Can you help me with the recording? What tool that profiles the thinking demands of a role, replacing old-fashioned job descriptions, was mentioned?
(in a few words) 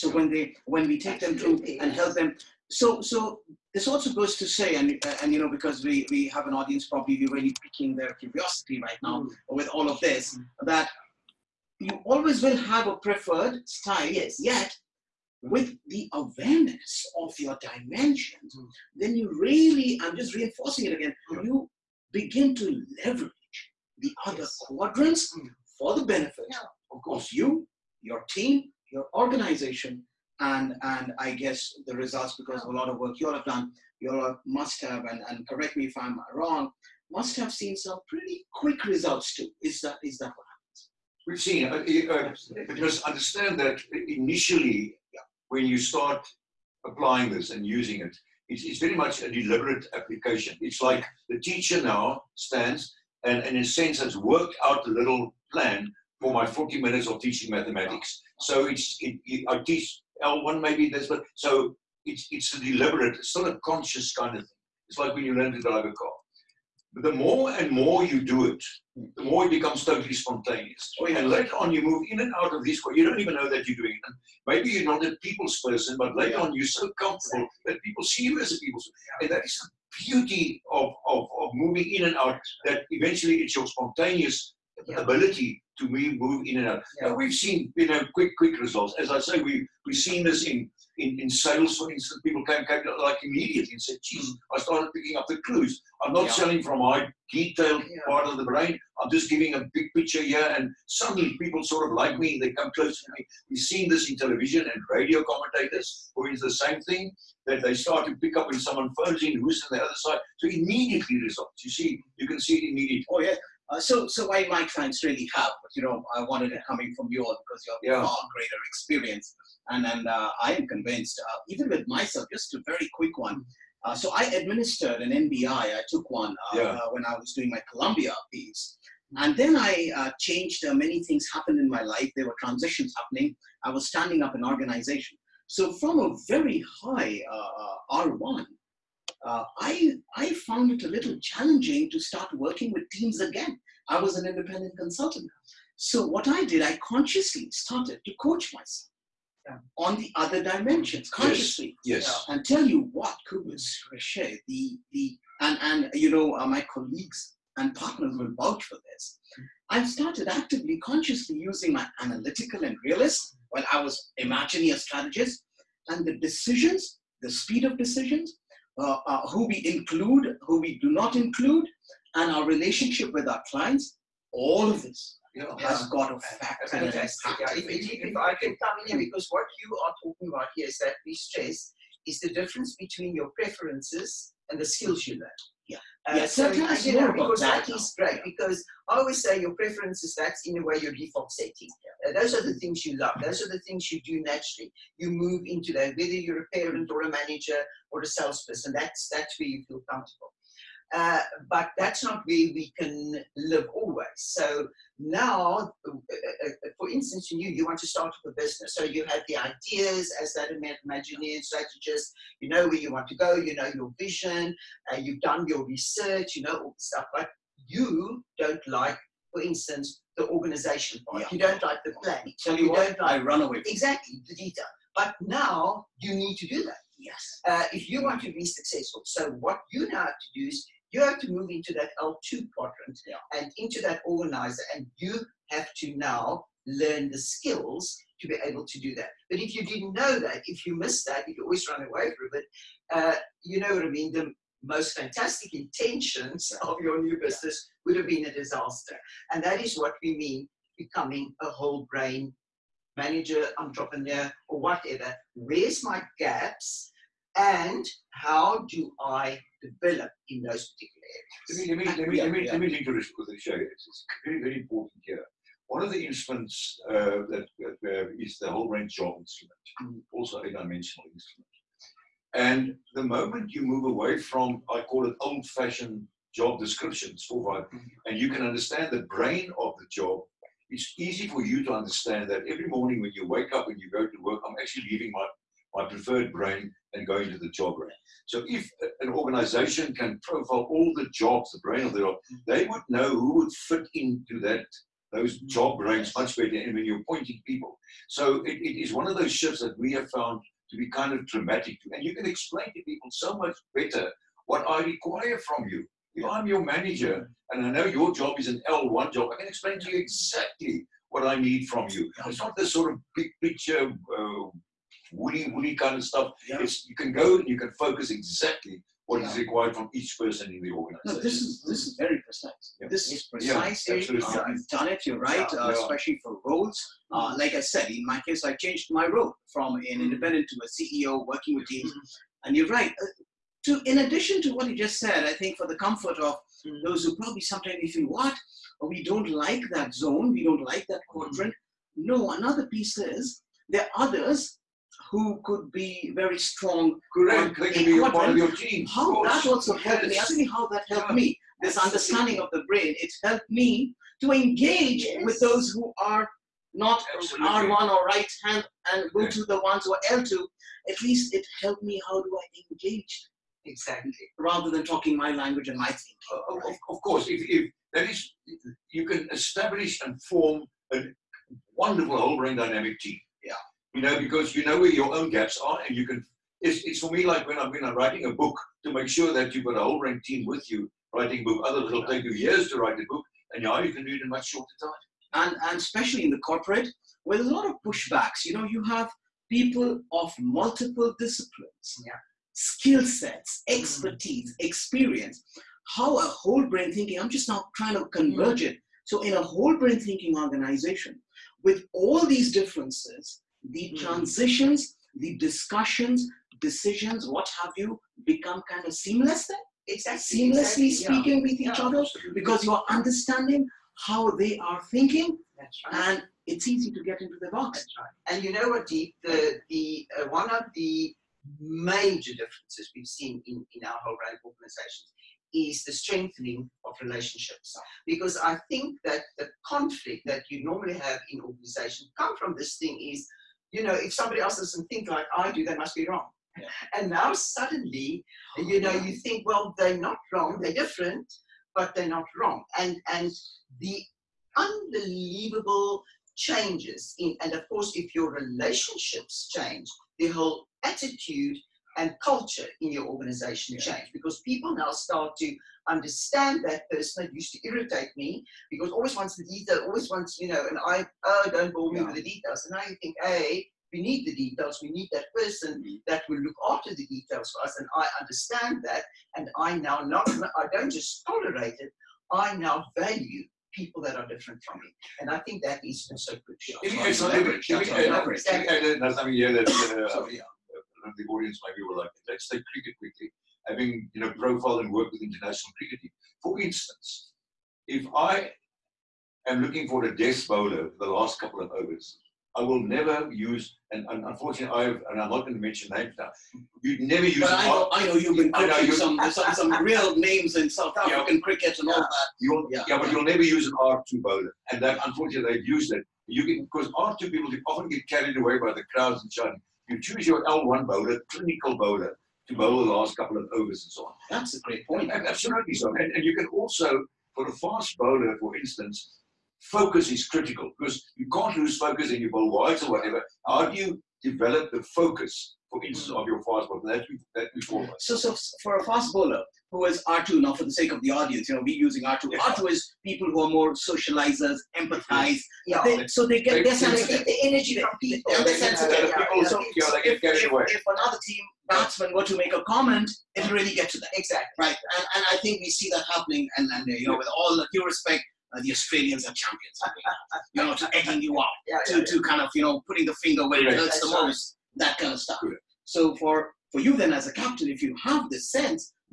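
Whole range job instrument.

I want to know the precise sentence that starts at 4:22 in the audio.
let me link to this quickly, It's very, very important here.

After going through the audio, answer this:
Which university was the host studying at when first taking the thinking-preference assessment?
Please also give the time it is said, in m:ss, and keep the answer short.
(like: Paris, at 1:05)
Columbia, at 2:07.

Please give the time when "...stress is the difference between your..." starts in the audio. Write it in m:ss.
3:01.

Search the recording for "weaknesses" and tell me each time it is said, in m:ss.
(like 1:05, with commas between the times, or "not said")
not said.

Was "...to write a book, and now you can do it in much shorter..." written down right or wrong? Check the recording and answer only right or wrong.
right.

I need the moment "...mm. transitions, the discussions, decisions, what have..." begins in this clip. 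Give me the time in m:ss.
6:43.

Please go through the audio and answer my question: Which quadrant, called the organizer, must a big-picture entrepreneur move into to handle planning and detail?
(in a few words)
L2.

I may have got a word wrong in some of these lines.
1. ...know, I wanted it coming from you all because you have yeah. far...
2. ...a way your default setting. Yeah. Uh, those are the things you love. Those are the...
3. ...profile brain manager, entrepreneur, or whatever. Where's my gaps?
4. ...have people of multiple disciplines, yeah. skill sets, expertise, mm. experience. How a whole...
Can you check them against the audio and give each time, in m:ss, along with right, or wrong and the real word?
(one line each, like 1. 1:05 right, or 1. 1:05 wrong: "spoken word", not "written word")
1. 1:55 right
2. 3:10 right
3. 4:11 wrong: "whole", not "profile"
4. 6:28 right.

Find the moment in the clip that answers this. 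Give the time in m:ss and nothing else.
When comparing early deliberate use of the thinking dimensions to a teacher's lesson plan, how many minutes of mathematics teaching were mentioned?
0:56.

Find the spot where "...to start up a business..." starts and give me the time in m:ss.
3:27.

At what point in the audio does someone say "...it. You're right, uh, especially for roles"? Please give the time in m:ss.
5:24.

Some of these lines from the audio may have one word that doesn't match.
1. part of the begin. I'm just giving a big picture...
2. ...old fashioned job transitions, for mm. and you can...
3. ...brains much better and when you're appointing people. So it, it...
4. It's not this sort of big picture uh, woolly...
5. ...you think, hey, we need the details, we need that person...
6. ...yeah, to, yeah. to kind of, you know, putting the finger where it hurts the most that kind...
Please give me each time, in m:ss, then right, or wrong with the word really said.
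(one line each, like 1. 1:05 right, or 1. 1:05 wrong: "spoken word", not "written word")
1. 1:38 wrong: "brain", not "begin"
2. 4:35 wrong: "descriptions", not "transitions"
3. 4:55 right
4. 5:12 right
5. 7:42 right
6. 9:11 right.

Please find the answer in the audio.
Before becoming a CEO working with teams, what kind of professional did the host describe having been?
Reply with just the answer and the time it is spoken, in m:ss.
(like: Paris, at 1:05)
Independent consultant, at 2:24.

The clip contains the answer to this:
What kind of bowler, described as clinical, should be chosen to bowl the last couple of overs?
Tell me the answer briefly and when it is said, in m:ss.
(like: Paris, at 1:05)
L1 bowler, at 8:30.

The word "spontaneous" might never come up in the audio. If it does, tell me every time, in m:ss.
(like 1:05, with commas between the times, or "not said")
1:10, 1:23.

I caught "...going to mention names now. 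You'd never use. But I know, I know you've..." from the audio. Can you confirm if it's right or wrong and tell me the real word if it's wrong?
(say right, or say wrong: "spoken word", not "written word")
right.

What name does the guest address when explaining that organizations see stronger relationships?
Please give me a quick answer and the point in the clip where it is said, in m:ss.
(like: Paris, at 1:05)
Deep, at 6:58.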